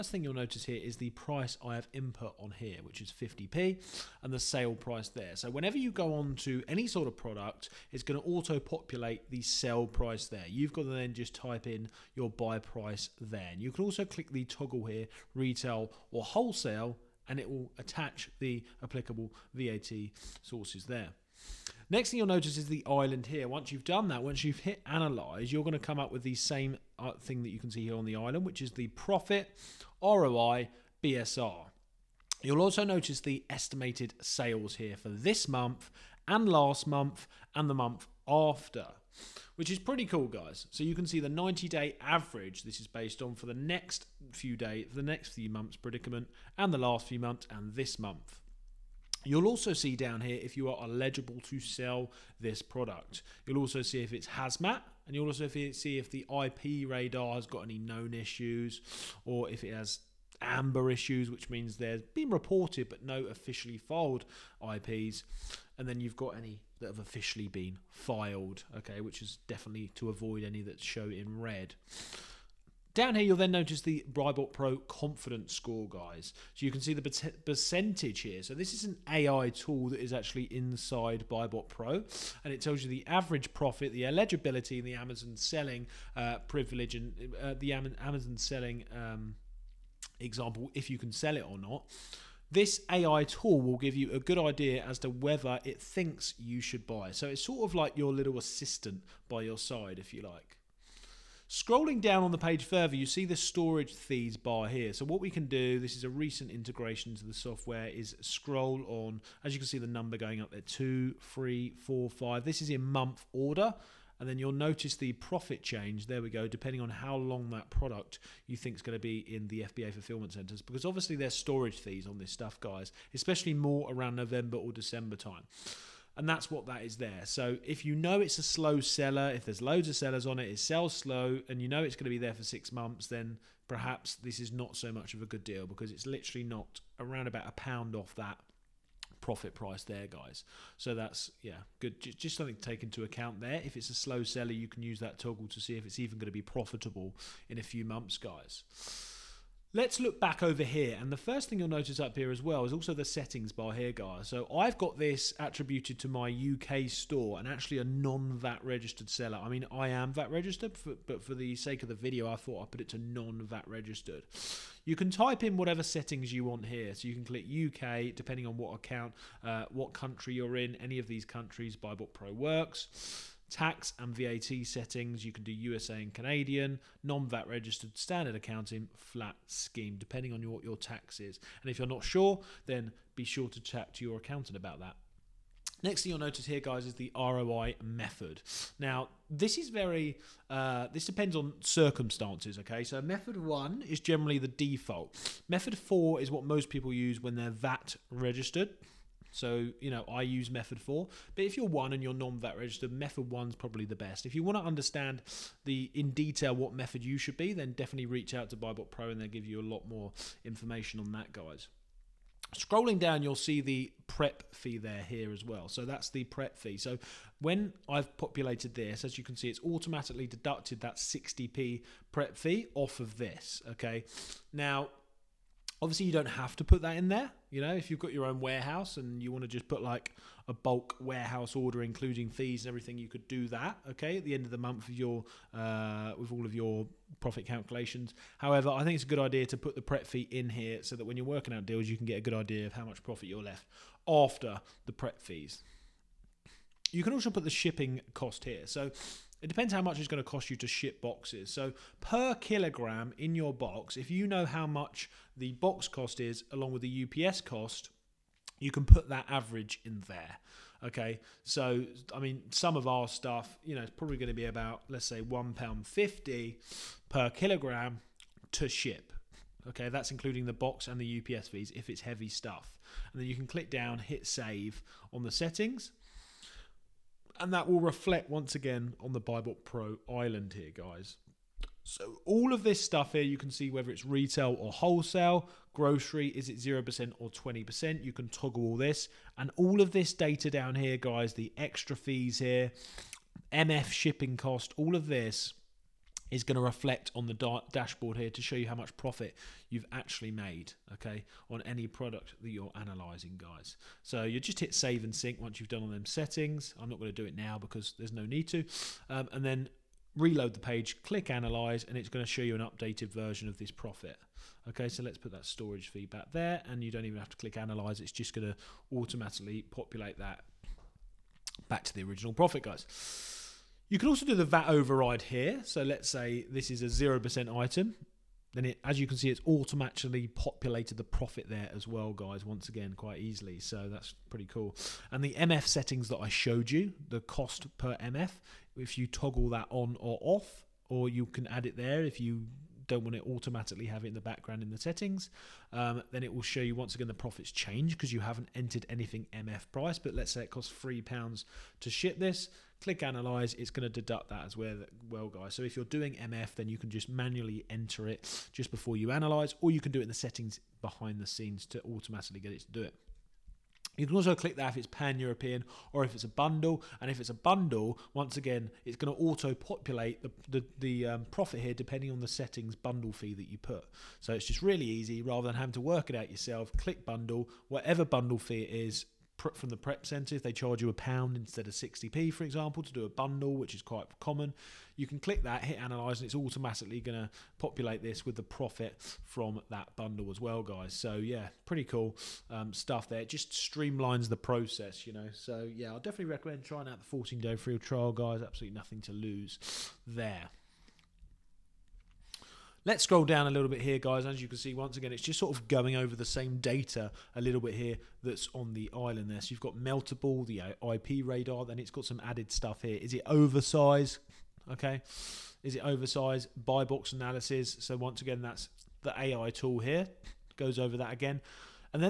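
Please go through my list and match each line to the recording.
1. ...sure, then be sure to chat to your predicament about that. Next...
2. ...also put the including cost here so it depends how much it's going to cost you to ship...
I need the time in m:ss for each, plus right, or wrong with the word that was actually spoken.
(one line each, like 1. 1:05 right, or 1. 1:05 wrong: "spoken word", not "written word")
1. 3:02 wrong: "accountant", not "predicament"
2. 4:07 wrong: "shipping", not "including".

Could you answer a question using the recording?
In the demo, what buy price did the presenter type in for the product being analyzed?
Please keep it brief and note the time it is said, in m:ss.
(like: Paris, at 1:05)
50p, at 0:03.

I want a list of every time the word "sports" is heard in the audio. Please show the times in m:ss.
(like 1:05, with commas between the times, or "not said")
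not said.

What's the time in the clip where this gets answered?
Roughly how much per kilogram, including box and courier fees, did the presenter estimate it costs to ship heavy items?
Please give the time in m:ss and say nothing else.
4:25.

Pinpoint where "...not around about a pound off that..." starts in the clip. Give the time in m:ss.
2:16.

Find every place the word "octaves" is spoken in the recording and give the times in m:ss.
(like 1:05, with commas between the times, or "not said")
not said.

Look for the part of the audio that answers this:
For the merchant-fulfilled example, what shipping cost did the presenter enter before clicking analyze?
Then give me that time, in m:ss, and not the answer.
5:50.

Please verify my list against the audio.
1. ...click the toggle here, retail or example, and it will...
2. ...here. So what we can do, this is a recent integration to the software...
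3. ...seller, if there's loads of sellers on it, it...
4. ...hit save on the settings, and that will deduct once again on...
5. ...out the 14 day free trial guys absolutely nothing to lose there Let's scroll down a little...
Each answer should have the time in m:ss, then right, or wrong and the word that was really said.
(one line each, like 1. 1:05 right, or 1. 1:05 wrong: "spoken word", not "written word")
1. 0:14 wrong: "wholesale", not "example"
2. 1:44 right
3. 2:08 right
4. 4:33 wrong: "reflect", not "deduct"
5. 6:36 right.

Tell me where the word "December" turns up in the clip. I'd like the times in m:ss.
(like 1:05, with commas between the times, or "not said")
2:04.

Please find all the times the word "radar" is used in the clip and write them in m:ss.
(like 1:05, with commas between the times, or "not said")
0:56, 6:51.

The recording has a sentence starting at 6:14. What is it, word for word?
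So it's just really easy rather than having to work it out yourself.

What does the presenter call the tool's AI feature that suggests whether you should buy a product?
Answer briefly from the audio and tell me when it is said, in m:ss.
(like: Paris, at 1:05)
BuyBot Pro confidence score, at 1:14.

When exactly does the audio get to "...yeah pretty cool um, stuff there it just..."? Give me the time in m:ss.
6:31.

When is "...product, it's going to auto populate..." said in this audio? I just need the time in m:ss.
0:07.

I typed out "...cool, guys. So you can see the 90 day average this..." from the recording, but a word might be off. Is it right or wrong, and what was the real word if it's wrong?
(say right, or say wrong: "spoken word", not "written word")
right.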